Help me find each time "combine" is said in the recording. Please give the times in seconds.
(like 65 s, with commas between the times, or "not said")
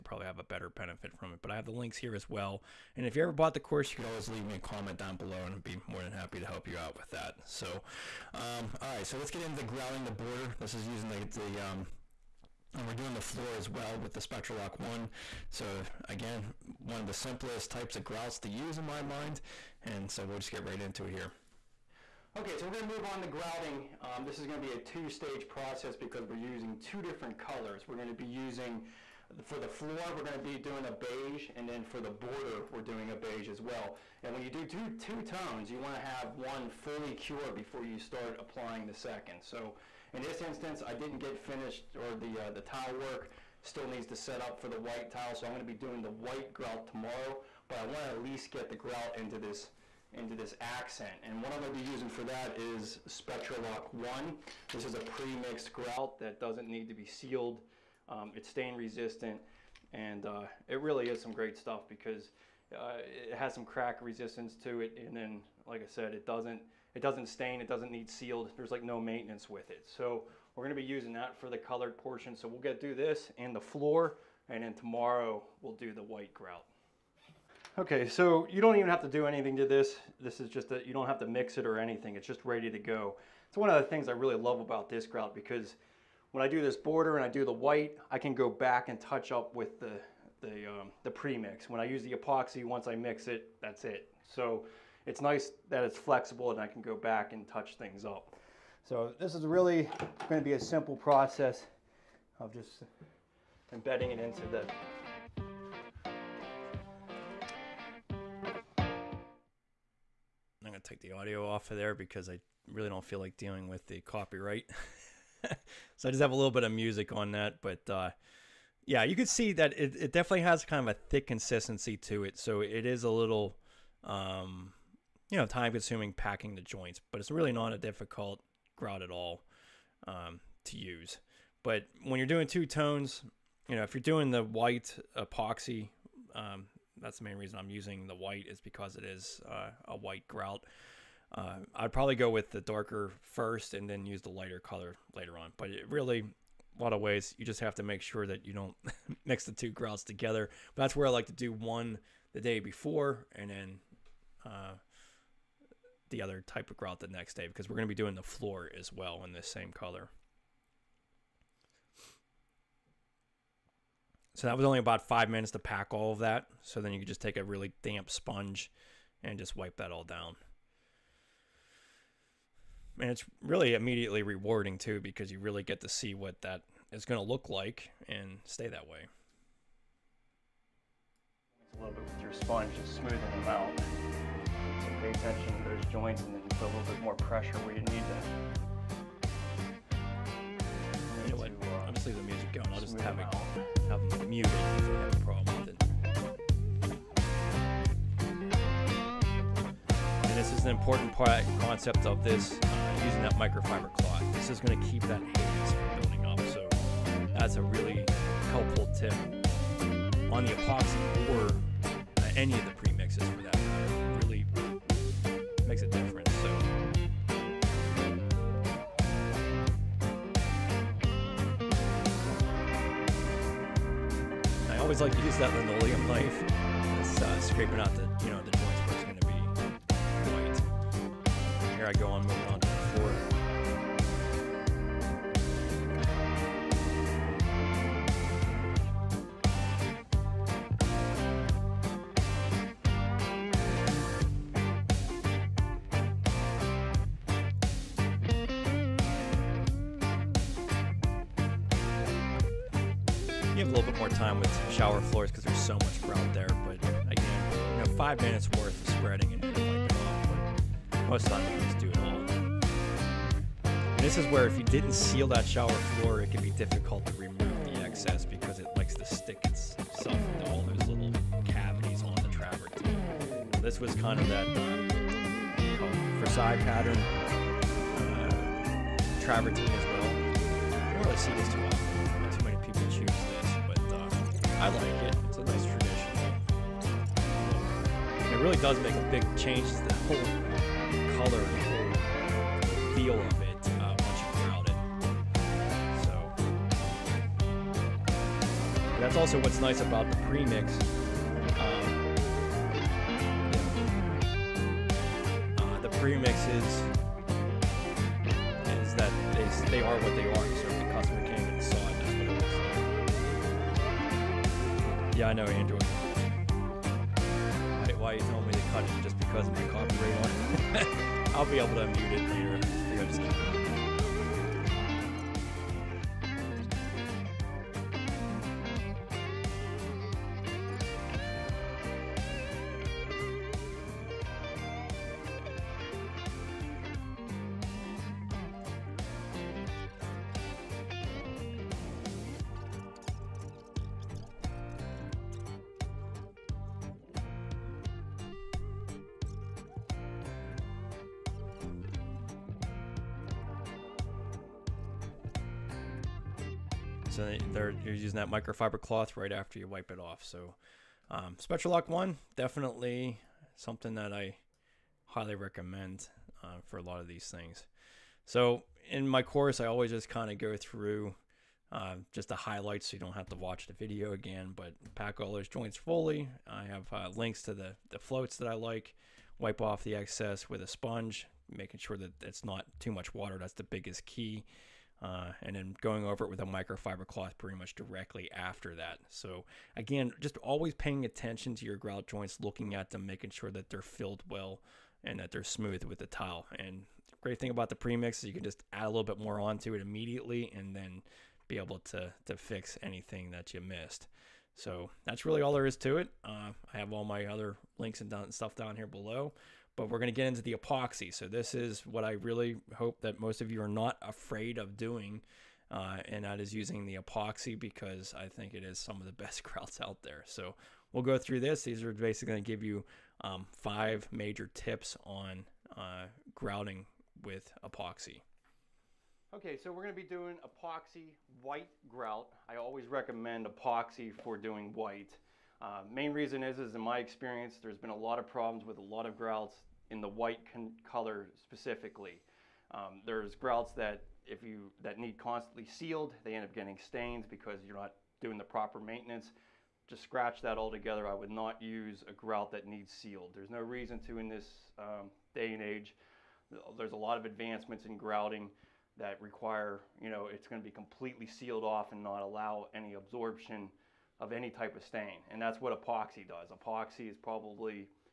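not said.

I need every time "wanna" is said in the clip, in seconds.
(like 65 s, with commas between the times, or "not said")
35 s, 47 s.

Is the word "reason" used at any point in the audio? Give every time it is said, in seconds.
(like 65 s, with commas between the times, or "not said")
137 s, 436 s, 453 s.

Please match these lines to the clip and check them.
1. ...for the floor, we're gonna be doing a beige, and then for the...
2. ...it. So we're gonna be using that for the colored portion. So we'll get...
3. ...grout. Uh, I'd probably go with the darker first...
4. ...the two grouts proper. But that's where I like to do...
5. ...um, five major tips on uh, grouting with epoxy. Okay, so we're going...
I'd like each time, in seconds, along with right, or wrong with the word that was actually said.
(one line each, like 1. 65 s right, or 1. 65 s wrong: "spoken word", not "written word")
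1. 29 s right
2. 69 s right
3. 140 s right
4. 149 s wrong: "together", not "proper"
5. 423 s right.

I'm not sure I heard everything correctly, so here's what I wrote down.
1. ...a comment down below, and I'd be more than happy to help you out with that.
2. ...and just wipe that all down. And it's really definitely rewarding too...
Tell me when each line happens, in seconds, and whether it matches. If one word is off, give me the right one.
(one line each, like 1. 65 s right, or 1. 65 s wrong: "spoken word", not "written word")
1. 4 s right
2. 169 s wrong: "immediately", not "definitely".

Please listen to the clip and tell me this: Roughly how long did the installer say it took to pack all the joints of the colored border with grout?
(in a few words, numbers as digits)
five minutes.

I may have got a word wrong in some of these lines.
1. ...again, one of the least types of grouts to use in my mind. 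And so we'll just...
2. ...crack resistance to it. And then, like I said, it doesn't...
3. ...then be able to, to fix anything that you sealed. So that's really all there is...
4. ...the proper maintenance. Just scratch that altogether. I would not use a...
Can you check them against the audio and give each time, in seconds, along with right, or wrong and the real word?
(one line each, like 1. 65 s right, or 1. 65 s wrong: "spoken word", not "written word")
1. 16 s wrong: "simplest", not "least"
2. 63 s right
3. 400 s wrong: "missed", not "sealed"
4. 448 s right.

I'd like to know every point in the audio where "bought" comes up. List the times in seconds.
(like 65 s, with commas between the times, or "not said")
3 s.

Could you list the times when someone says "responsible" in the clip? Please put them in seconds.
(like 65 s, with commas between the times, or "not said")
not said.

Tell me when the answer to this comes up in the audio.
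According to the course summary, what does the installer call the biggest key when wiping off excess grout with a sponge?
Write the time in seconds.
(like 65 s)
382 s.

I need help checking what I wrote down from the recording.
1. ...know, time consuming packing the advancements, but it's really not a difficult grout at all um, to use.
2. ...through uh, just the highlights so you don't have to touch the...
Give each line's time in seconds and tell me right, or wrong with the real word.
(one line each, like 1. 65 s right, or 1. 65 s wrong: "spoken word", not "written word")
1. 125 s wrong: "joints", not "advancements"
2. 370 s wrong: "watch", not "touch".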